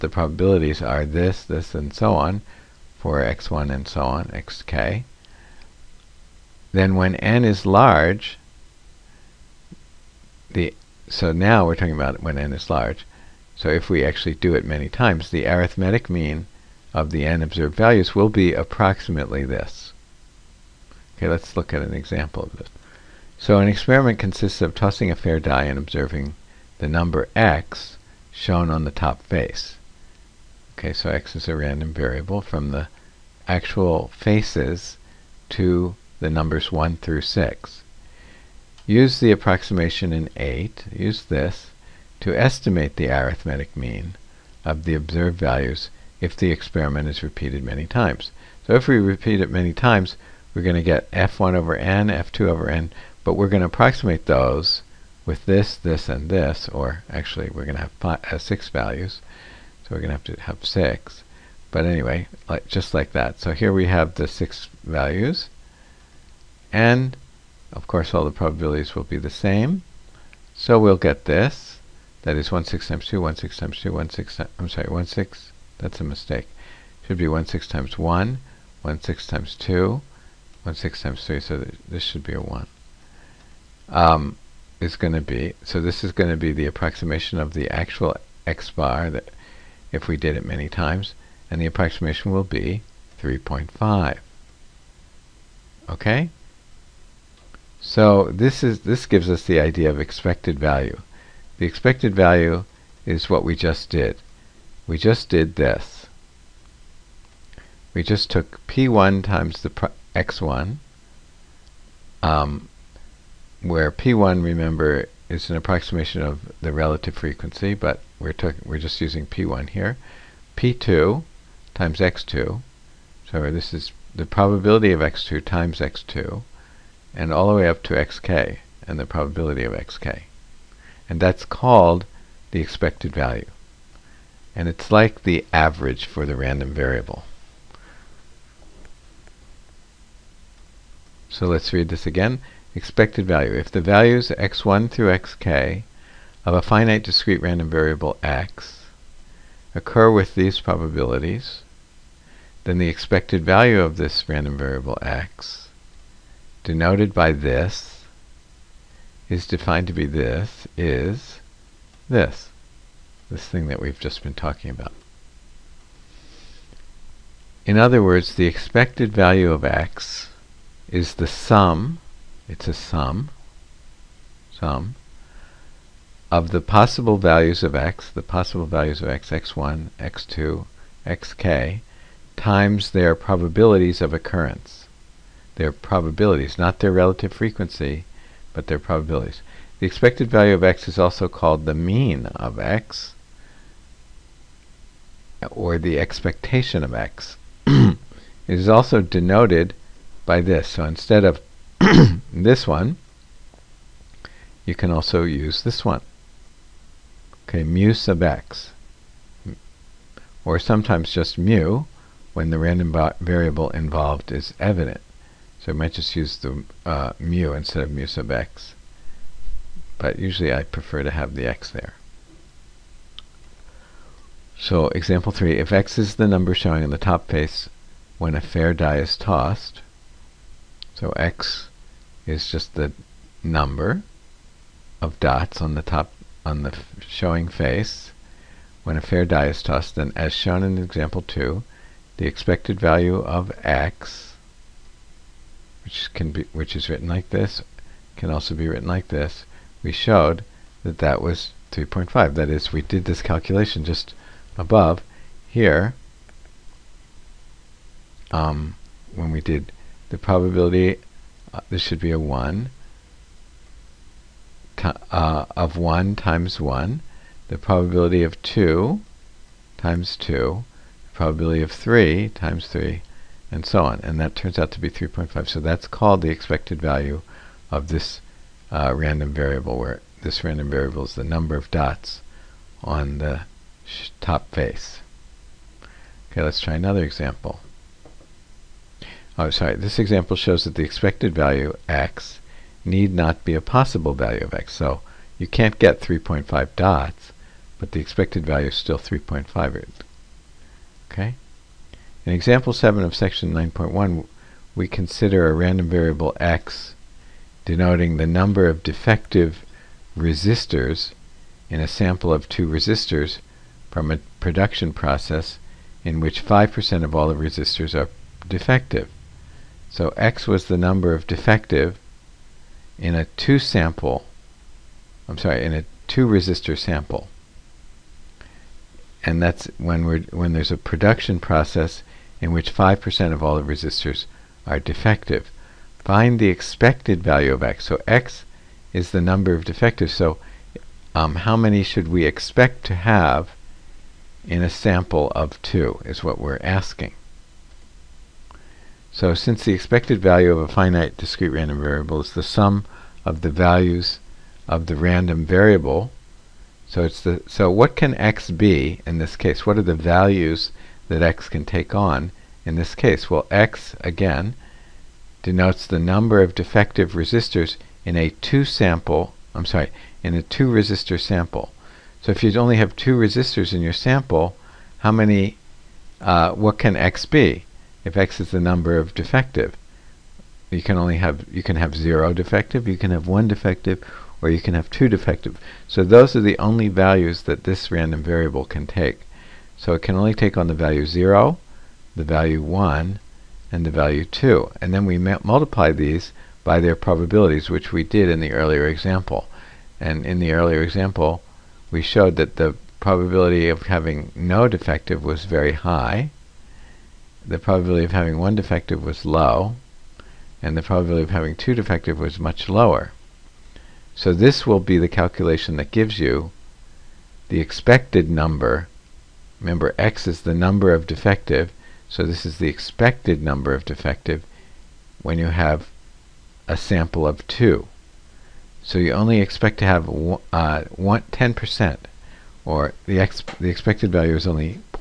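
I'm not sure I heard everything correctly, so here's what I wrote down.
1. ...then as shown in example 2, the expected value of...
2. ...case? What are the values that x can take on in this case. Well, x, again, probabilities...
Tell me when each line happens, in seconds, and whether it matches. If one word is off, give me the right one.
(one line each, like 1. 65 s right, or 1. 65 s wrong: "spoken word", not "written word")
1. 239 s right
2. 359 s wrong: "denotes", not "probabilities".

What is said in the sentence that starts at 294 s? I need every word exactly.
So you can't get 3.5 dots, but the expected value is still 3.5.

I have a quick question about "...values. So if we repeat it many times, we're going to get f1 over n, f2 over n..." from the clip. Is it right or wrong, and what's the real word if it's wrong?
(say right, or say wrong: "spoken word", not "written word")
wrong: "times", not "values".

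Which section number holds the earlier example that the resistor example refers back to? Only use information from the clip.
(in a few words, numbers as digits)
9.1.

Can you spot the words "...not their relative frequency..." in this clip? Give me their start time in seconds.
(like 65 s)
186 s.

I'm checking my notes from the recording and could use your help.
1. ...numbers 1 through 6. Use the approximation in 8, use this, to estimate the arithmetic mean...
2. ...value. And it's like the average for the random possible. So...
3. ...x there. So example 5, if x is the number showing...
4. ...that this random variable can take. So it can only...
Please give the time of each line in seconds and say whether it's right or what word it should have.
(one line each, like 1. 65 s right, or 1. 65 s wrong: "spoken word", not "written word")
1. 36 s right
2. 133 s wrong: "variable", not "possible"
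3. 221 s wrong: "3", not "5"
4. 387 s right.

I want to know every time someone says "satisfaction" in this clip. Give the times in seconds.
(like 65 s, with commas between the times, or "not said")
not said.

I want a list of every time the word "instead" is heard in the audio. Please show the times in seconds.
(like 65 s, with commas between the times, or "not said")
200 s, 217 s.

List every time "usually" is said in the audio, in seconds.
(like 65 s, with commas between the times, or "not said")
220 s.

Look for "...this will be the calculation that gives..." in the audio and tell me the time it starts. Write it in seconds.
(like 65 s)
414 s.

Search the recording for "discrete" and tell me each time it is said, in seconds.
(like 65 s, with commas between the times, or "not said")
147 s, 351 s.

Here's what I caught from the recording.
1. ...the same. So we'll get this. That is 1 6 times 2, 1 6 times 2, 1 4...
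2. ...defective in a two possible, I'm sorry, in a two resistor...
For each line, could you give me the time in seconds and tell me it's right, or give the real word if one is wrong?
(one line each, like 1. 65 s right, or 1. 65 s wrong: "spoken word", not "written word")
1. 69 s wrong: "6", not "4"
2. 321 s wrong: "sample", not "possible".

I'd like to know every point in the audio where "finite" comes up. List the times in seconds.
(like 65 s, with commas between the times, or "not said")
146 s, 350 s.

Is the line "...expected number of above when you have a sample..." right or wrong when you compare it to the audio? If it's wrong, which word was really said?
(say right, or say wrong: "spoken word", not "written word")
wrong: "defective", not "above".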